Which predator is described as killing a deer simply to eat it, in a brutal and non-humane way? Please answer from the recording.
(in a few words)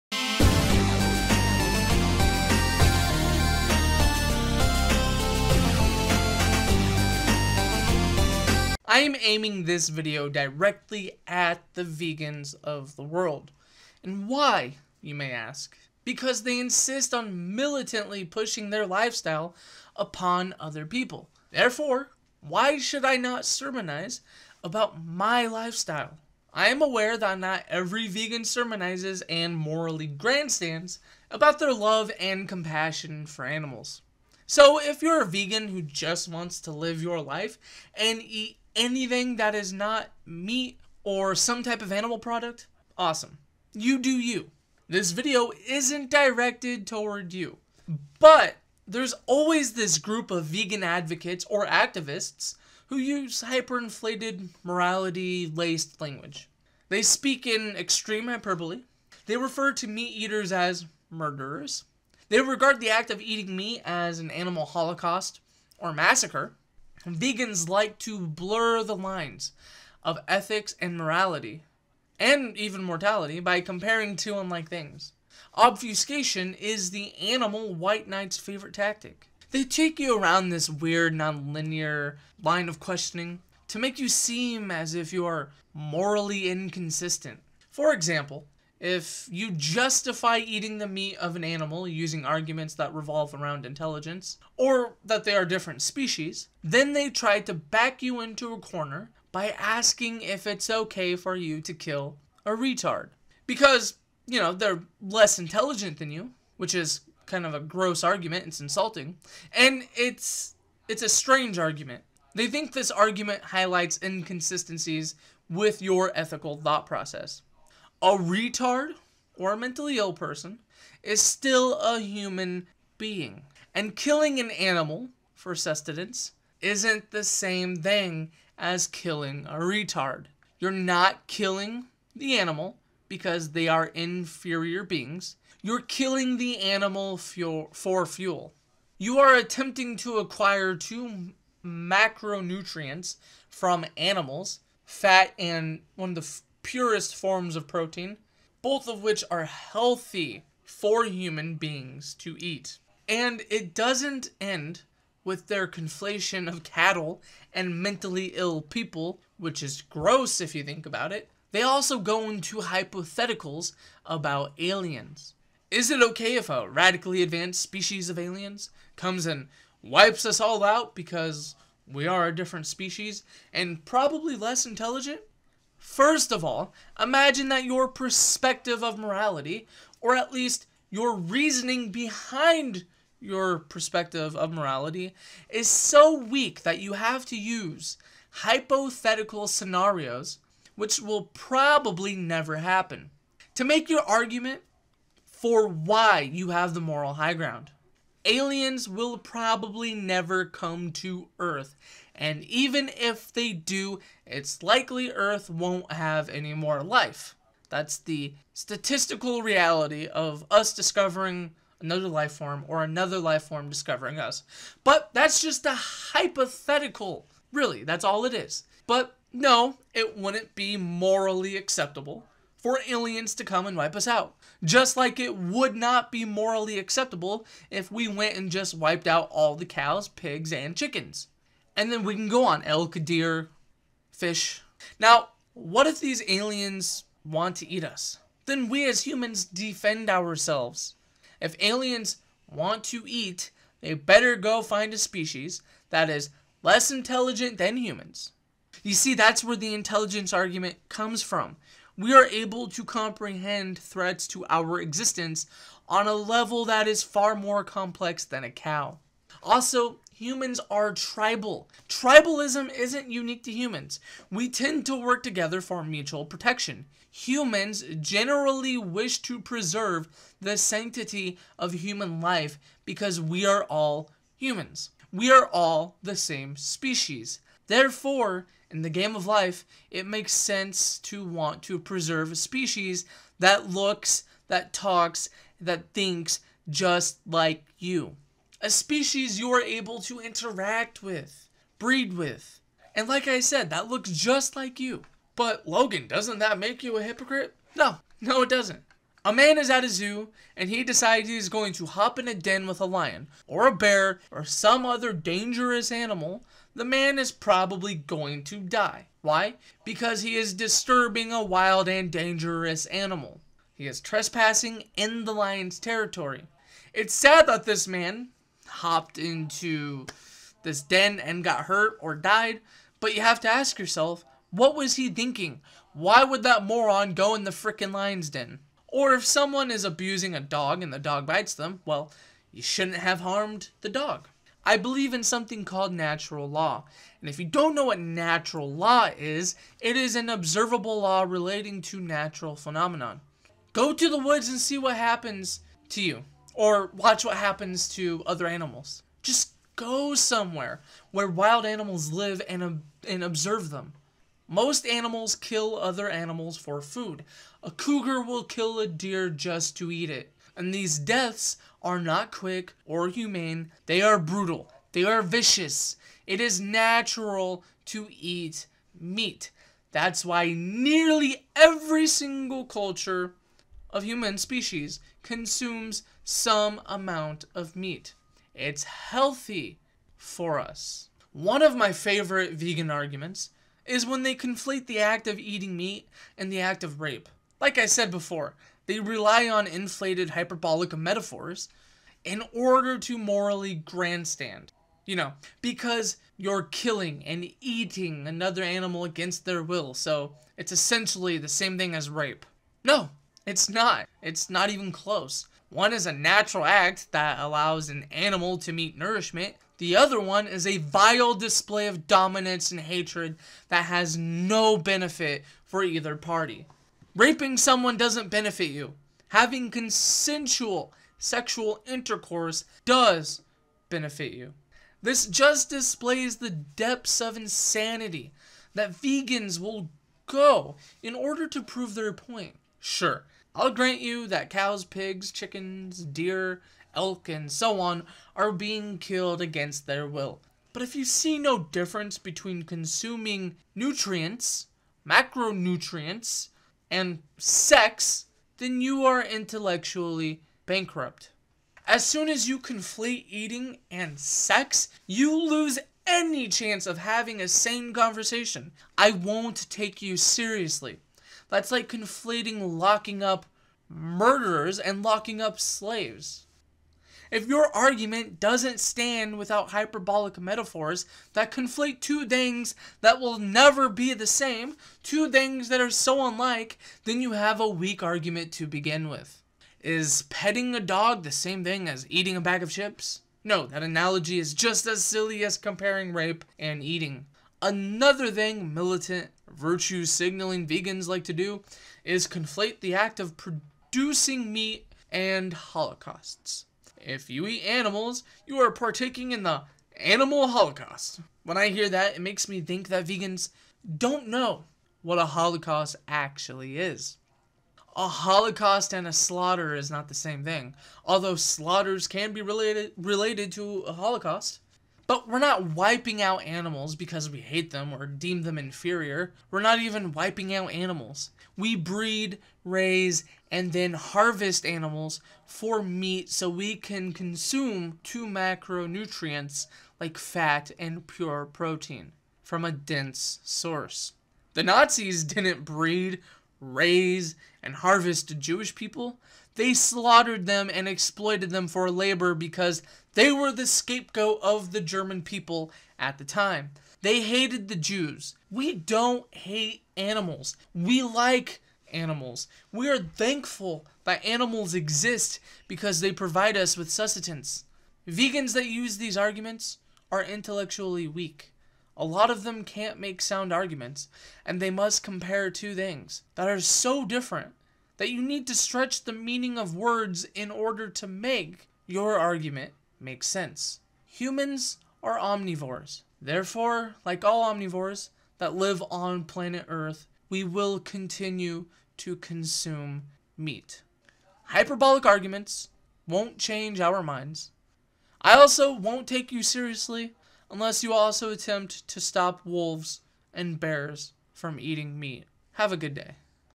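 cougar.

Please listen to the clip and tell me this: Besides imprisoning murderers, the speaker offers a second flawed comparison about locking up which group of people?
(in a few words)
slaves.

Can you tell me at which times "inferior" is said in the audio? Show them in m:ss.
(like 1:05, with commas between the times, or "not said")
2:13, 8:38.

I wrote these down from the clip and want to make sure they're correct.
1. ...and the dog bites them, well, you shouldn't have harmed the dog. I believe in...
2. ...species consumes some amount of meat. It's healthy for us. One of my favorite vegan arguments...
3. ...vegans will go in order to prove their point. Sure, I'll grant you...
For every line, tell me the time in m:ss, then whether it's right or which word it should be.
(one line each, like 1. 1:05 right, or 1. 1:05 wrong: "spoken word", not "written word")
1. 5:30 right
2. 6:14 right
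3. 7:08 right.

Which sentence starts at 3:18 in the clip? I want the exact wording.
Aliens will probably never come to Earth, and even if they do, it's likely Earth won't have any more life.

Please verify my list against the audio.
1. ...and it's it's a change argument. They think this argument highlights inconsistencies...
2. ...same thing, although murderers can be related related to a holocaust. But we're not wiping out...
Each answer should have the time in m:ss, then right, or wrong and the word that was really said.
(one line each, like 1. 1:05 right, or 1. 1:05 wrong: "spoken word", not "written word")
1. 1:49 wrong: "strange", not "change"
2. 8:30 wrong: "slaughters", not "murderers".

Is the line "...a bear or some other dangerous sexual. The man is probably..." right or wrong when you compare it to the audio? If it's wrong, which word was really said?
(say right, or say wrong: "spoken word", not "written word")
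wrong: "animal", not "sexual".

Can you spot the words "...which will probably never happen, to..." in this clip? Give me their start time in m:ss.
3:10.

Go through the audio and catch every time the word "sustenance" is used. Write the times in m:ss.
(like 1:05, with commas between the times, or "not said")
2:05, 9:16.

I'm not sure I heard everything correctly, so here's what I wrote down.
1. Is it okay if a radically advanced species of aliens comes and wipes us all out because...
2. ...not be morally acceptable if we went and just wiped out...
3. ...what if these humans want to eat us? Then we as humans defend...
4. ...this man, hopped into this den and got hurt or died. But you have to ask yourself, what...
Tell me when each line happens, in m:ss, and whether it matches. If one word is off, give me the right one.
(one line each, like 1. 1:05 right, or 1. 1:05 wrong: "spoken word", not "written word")
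1. 2:45 right
2. 3:45 right
3. 3:55 wrong: "aliens", not "humans"
4. 5:17 right.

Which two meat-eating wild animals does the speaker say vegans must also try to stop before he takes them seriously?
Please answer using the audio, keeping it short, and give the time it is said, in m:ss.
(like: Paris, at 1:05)
wolves and bears, at 9:52.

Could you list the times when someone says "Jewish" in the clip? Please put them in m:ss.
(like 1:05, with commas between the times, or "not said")
8:58.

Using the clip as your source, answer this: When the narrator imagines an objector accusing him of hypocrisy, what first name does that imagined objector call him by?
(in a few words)
Logan.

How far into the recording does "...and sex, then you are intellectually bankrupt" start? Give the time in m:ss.
7:26.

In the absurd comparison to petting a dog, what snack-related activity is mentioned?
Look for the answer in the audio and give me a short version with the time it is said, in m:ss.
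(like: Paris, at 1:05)
eating a bag of chips, at 8:02.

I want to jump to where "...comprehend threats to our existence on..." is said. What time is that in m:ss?
4:12.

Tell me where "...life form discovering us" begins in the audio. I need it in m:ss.
3:33.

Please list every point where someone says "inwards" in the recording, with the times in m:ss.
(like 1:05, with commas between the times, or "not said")
not said.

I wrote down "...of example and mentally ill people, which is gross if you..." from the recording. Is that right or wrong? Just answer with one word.
wrong.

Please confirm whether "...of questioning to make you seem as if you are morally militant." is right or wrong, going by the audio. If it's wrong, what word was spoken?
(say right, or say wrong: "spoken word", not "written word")
wrong: "inconsistent", not "militant".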